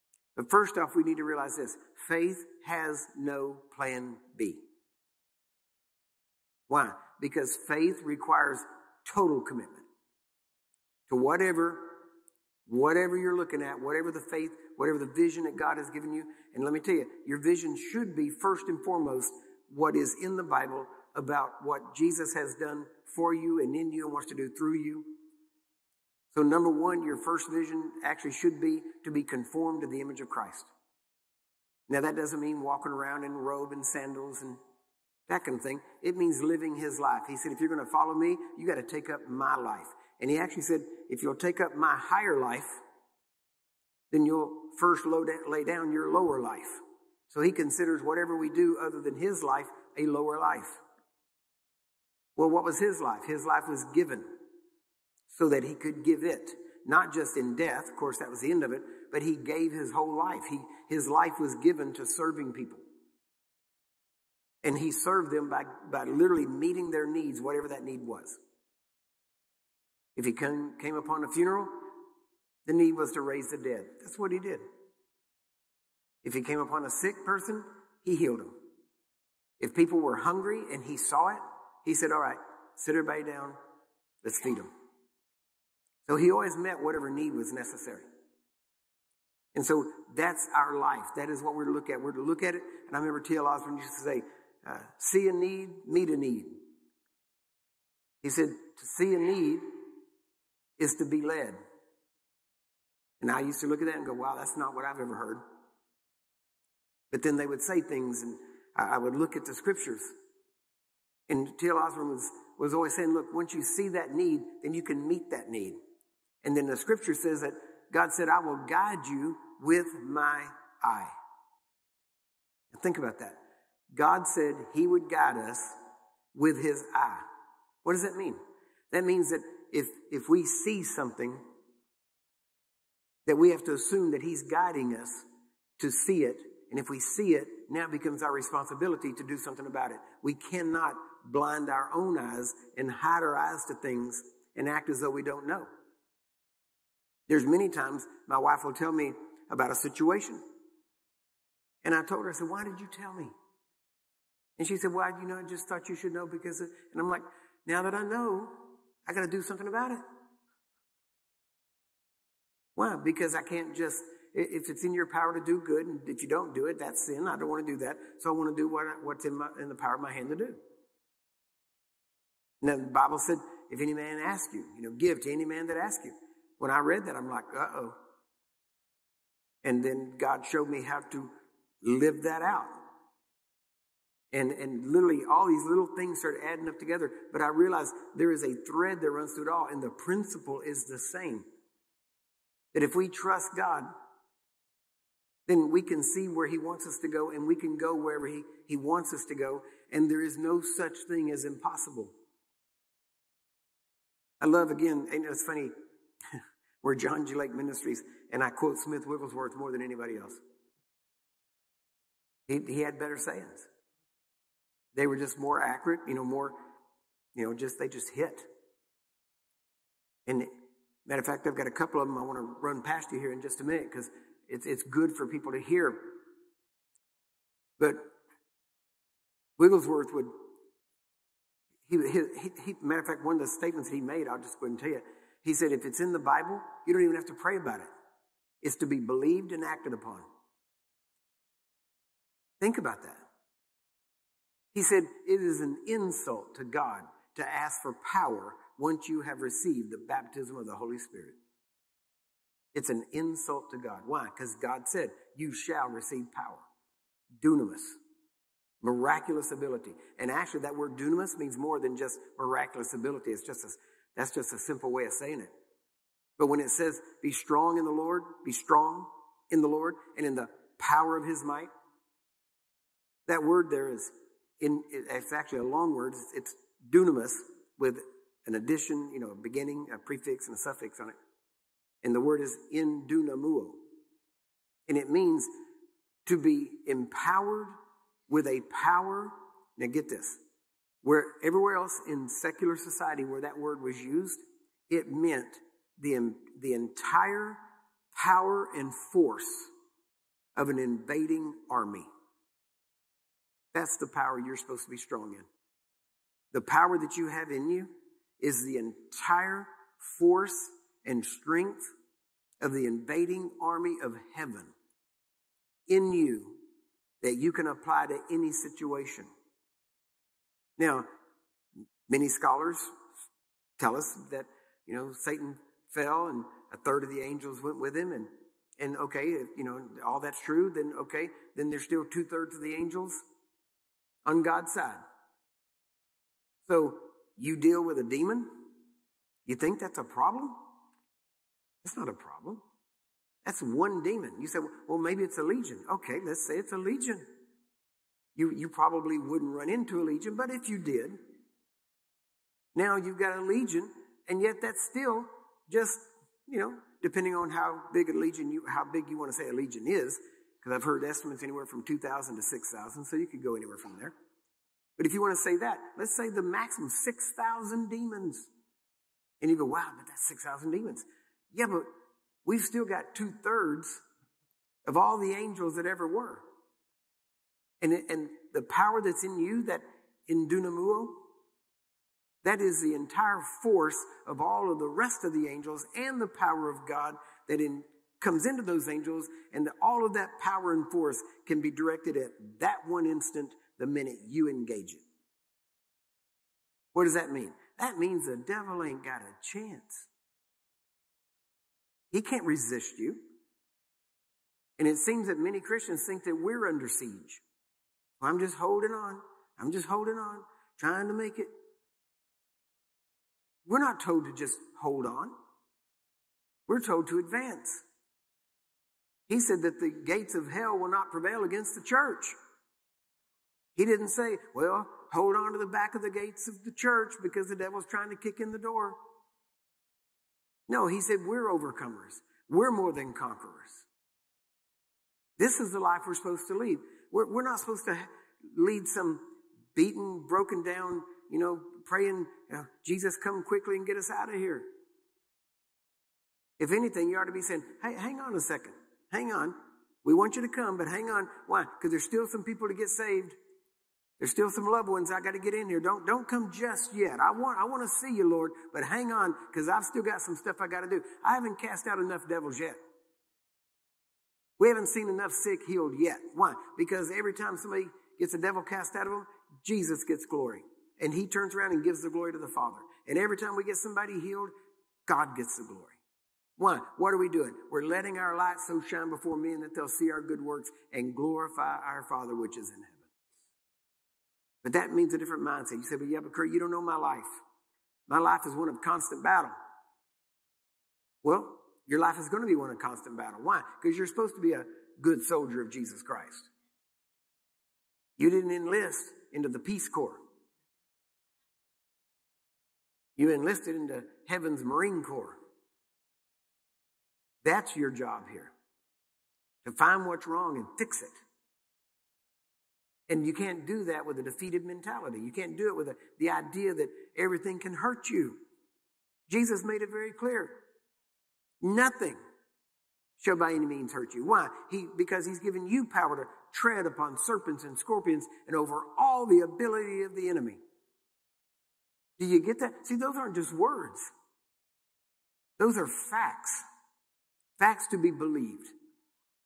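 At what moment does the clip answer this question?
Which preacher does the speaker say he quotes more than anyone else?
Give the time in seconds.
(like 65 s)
208 s.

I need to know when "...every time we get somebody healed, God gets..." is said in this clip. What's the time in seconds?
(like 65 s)
473 s.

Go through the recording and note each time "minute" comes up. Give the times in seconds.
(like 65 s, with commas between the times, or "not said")
223 s, 393 s.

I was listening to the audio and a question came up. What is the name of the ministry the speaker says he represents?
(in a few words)
John G. Lake Ministries.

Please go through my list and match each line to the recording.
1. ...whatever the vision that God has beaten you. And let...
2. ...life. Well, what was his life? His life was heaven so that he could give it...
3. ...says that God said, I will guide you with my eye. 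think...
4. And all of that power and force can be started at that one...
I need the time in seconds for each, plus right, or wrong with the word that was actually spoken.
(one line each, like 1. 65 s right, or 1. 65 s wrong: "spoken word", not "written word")
1. 14 s wrong: "given", not "beaten"
2. 50 s wrong: "given", not "heaven"
3. 117 s right
4. 389 s wrong: "directed", not "started".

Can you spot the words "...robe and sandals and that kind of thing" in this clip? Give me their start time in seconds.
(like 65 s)
33 s.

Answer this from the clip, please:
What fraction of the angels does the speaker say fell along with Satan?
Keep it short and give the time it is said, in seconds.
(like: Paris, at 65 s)
a third, at 326 s.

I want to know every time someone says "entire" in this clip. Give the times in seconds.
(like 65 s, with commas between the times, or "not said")
296 s, 308 s, 382 s.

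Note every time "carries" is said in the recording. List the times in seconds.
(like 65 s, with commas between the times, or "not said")
not said.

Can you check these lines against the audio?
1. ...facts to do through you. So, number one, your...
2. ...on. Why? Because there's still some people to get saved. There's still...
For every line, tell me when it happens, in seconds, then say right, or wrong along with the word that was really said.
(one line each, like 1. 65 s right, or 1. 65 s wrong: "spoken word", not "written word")
1. 24 s wrong: "wants", not "facts"
2. 451 s right.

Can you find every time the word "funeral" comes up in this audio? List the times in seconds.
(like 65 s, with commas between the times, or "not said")
71 s.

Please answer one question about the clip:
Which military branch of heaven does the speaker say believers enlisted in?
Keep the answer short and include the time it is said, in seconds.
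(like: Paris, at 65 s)
Heaven's Marine Corps, at 504 s.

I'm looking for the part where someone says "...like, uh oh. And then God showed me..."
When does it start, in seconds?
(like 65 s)
177 s.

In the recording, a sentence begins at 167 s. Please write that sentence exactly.
I don't want to do that.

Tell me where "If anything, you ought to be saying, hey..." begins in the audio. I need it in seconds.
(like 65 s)
446 s.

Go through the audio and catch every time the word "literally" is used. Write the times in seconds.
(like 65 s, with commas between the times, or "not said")
66 s, 184 s.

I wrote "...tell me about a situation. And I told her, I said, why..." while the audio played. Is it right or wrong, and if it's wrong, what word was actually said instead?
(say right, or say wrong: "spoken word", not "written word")
right.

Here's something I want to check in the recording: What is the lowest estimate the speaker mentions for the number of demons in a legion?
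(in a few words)
2,000.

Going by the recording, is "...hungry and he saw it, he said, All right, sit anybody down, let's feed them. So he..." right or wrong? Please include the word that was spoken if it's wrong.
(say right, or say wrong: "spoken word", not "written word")
wrong: "everybody", not "anybody".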